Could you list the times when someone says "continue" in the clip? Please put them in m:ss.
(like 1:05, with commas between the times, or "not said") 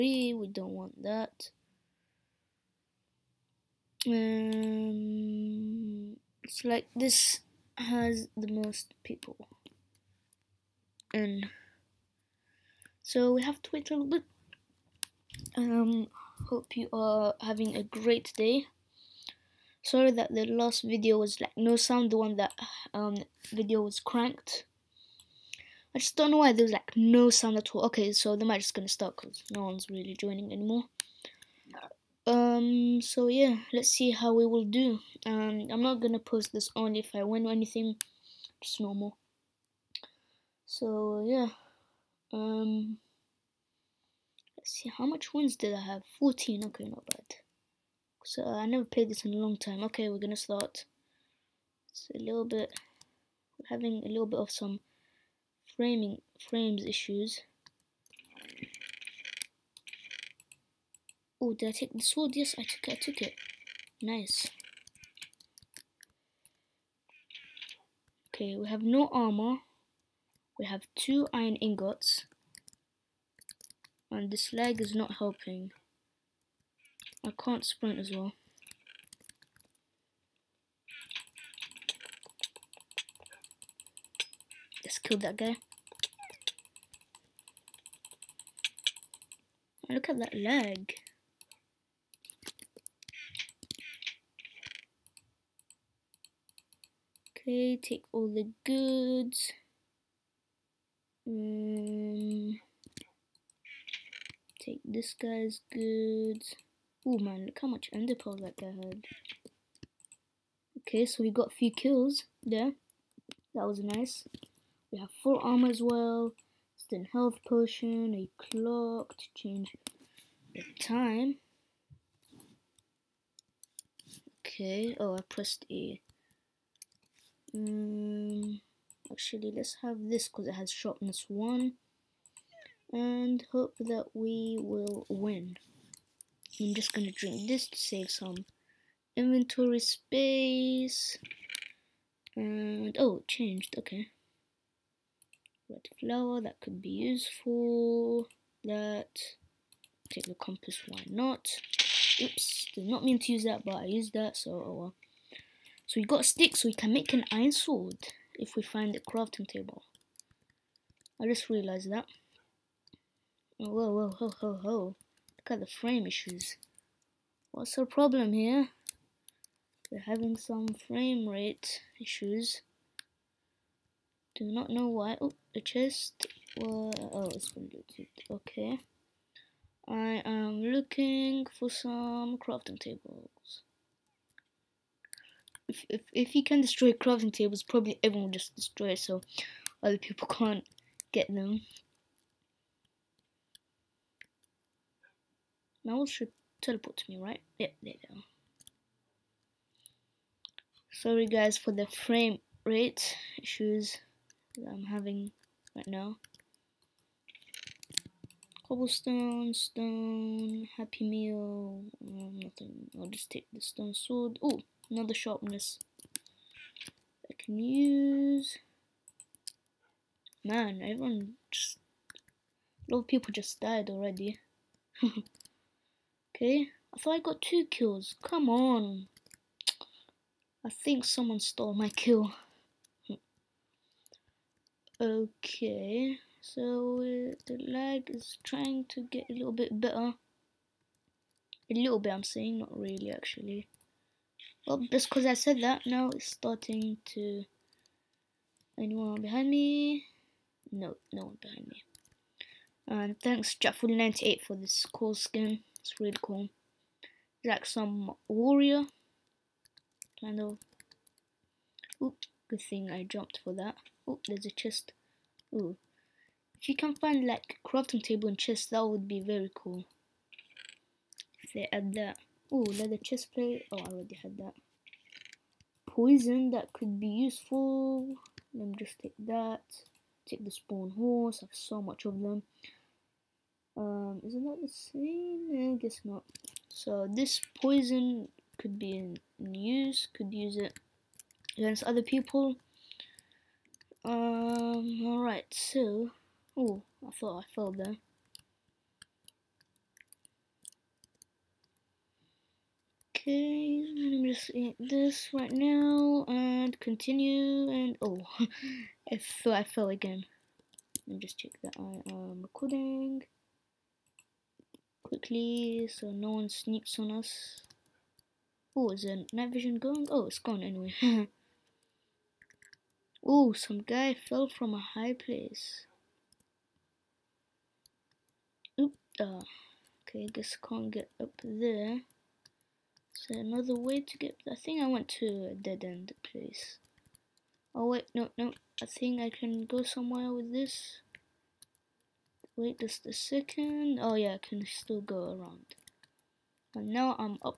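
5:06.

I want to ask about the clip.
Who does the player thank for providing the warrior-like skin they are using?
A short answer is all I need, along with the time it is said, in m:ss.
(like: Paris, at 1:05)
Jackful98, at 4:13.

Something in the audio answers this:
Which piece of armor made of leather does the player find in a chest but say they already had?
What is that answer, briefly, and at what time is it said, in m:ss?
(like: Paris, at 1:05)
Leather chest plate, at 4:32.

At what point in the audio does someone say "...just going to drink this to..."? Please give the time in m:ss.
2:16.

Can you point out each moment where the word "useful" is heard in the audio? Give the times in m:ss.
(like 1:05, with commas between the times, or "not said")
2:26, 4:37.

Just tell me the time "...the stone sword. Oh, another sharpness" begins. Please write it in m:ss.
3:33.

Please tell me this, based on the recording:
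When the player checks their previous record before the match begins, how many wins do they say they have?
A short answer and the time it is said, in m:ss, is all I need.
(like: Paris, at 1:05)
14, at 0:46.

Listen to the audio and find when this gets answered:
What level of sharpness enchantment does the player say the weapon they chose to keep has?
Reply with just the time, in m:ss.
2:10.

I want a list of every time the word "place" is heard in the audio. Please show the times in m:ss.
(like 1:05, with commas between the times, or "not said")
5:25, 5:36.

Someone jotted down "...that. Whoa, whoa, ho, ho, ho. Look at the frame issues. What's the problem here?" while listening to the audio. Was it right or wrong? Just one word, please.
right.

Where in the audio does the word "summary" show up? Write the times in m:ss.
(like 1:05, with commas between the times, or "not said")
not said.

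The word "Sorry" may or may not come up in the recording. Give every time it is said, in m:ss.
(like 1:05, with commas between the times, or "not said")
0:19, 3:20.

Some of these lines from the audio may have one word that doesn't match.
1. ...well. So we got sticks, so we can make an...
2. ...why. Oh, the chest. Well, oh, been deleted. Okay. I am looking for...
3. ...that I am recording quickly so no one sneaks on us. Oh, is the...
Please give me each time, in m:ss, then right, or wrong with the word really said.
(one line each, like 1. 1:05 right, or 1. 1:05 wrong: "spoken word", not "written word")
1. 2:34 right
2. 2:54 right
3. 5:11 right.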